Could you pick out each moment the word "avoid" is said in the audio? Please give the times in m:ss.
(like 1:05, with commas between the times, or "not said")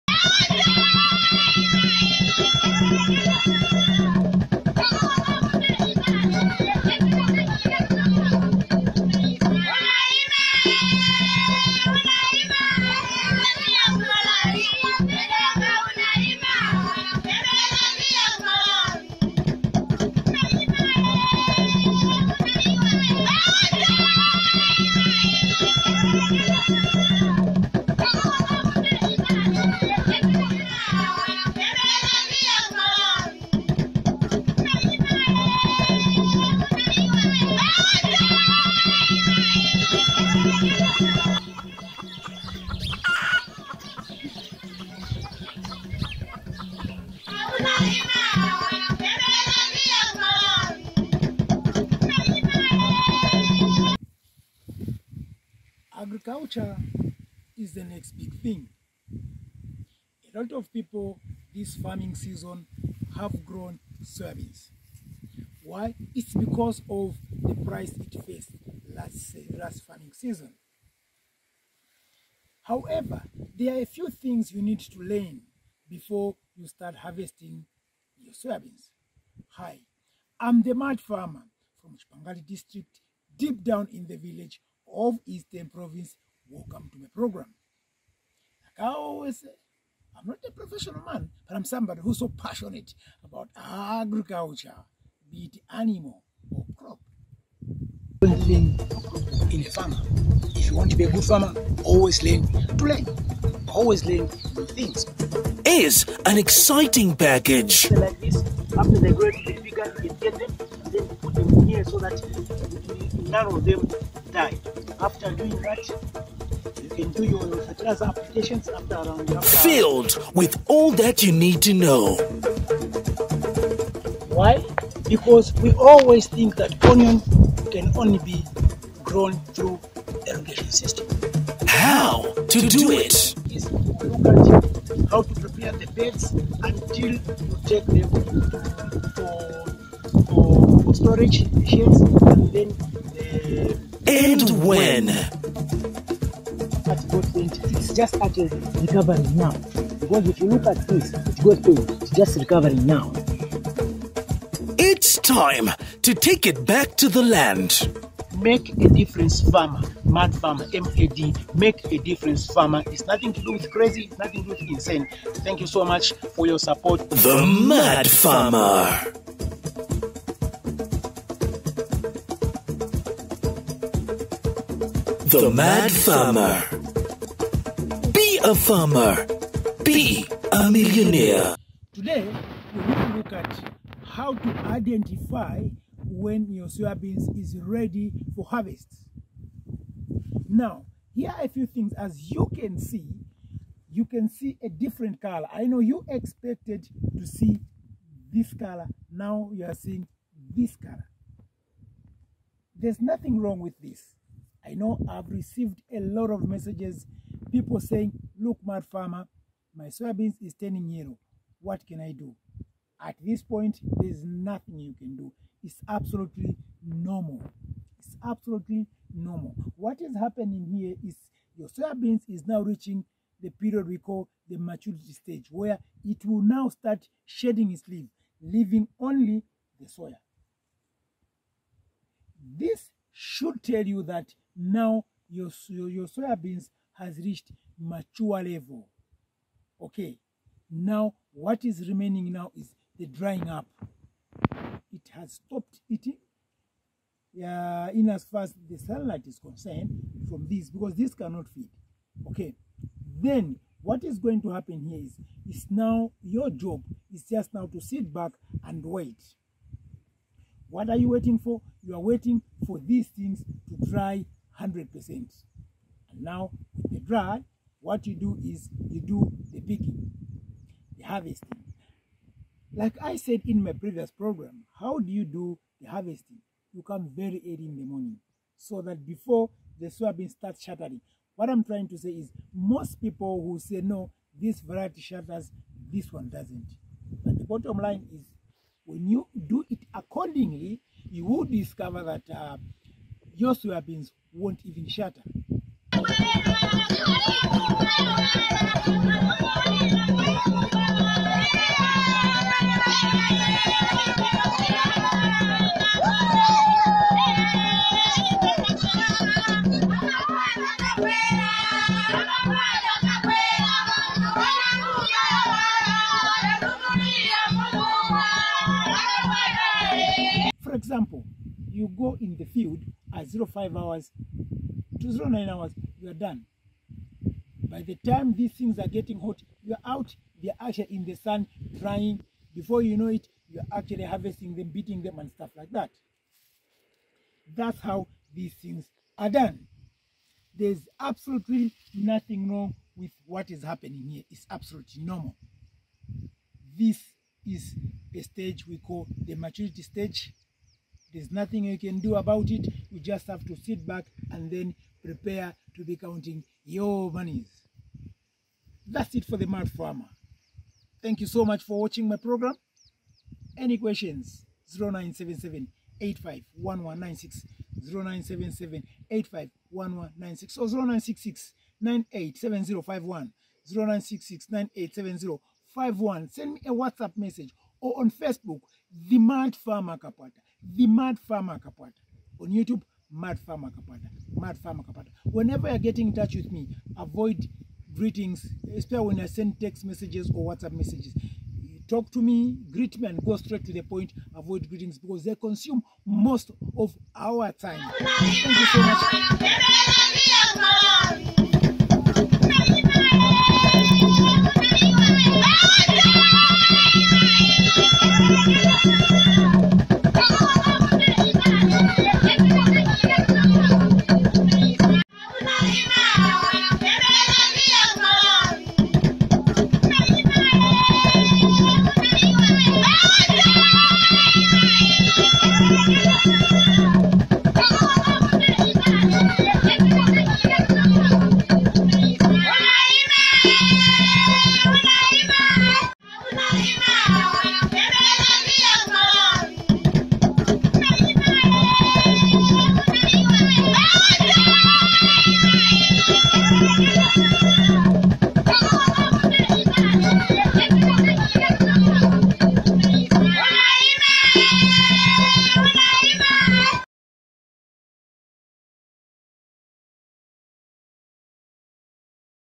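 6:26, 6:34.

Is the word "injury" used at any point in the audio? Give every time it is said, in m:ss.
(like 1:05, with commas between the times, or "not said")
not said.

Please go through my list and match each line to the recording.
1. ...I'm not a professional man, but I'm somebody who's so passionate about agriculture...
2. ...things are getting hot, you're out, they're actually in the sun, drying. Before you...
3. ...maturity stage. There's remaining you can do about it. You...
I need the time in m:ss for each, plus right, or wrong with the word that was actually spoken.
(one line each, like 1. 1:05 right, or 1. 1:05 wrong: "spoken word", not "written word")
1. 1:30 right
2. 5:28 right
3. 5:49 wrong: "nothing", not "remaining".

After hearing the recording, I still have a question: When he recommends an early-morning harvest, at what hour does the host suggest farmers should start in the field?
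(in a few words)
05 hours.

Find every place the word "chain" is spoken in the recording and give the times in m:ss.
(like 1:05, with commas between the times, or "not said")
not said.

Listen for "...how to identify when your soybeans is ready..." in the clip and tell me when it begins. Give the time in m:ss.
3:04.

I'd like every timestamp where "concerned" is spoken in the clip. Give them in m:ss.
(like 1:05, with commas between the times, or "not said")
4:09.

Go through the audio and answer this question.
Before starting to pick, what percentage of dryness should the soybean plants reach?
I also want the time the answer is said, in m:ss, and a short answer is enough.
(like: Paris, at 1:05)
100%, at 4:24.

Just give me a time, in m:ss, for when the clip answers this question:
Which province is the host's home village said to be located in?
1:25.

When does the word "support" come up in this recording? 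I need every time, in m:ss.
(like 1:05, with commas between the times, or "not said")
2:46.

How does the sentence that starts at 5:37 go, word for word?
That's how these things are done.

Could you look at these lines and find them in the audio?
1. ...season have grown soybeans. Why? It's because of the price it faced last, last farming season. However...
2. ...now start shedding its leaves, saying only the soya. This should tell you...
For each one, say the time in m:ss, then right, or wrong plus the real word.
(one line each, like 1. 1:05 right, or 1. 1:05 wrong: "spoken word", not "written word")
1. 1:02 right
2. 3:46 wrong: "leaving", not "saying".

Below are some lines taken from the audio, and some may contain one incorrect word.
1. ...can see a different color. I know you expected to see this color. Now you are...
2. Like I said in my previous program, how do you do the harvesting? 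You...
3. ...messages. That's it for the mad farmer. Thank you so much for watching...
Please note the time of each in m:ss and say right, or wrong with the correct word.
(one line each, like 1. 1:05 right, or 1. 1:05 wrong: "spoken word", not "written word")
1. 3:14 right
2. 4:32 right
3. 5:57 wrong: "monies", not "messages".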